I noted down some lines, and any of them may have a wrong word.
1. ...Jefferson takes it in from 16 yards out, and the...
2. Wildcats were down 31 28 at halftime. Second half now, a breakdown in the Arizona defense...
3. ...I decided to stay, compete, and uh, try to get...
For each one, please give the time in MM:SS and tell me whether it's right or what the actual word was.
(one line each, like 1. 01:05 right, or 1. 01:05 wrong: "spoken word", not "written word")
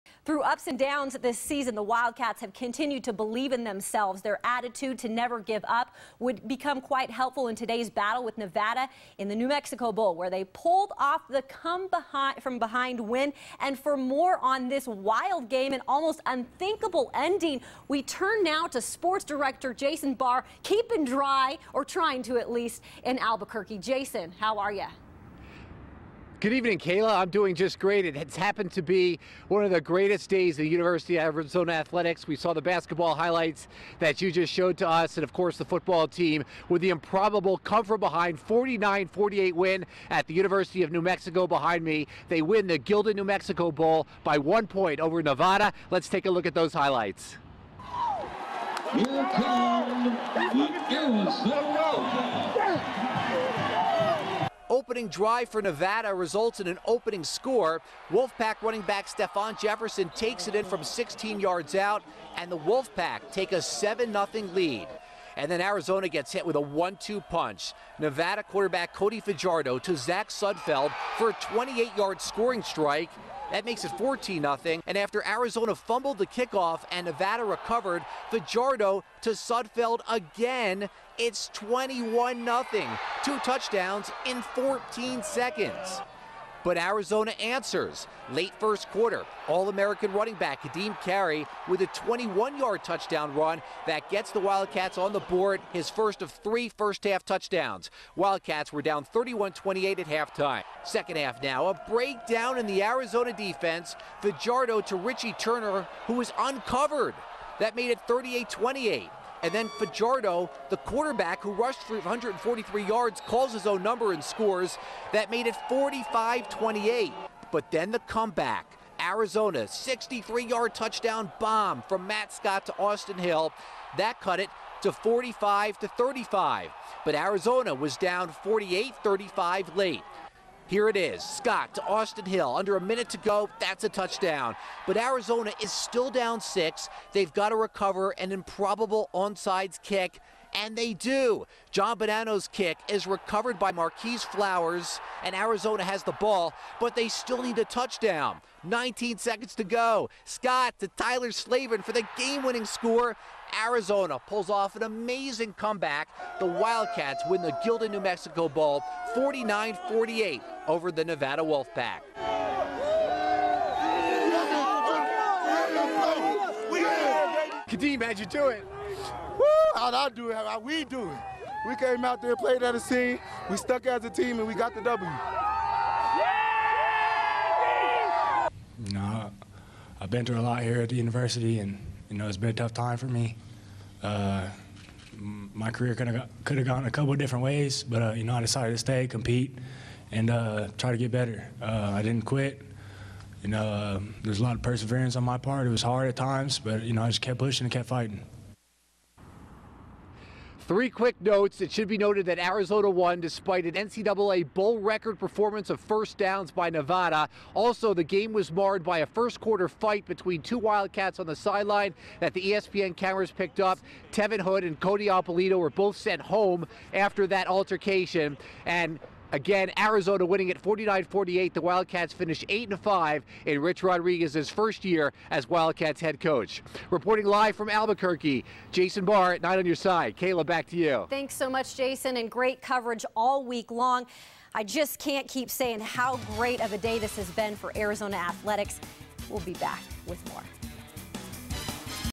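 1. 00:59 right
2. 01:38 right
3. 03:08 right.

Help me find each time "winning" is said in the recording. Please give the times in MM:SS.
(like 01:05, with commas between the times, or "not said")
02:32, 03:40.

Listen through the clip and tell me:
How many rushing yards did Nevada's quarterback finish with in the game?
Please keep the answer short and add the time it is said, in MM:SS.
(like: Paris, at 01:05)
143, at 01:51.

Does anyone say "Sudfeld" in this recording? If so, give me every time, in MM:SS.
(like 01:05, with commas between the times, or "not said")
01:10, 01:19.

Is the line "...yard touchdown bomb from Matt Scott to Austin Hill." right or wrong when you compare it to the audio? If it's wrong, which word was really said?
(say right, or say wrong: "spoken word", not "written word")
right.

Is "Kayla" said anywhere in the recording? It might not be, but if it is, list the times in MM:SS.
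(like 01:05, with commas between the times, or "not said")
00:26, 03:50.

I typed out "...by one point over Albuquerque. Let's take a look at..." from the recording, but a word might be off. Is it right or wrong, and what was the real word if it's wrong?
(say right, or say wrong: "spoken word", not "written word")
wrong: "Nevada", not "Albuquerque".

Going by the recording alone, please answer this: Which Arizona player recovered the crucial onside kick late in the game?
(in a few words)
Marquis Flowers.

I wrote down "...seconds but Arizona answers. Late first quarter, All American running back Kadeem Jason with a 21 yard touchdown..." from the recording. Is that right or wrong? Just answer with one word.
wrong.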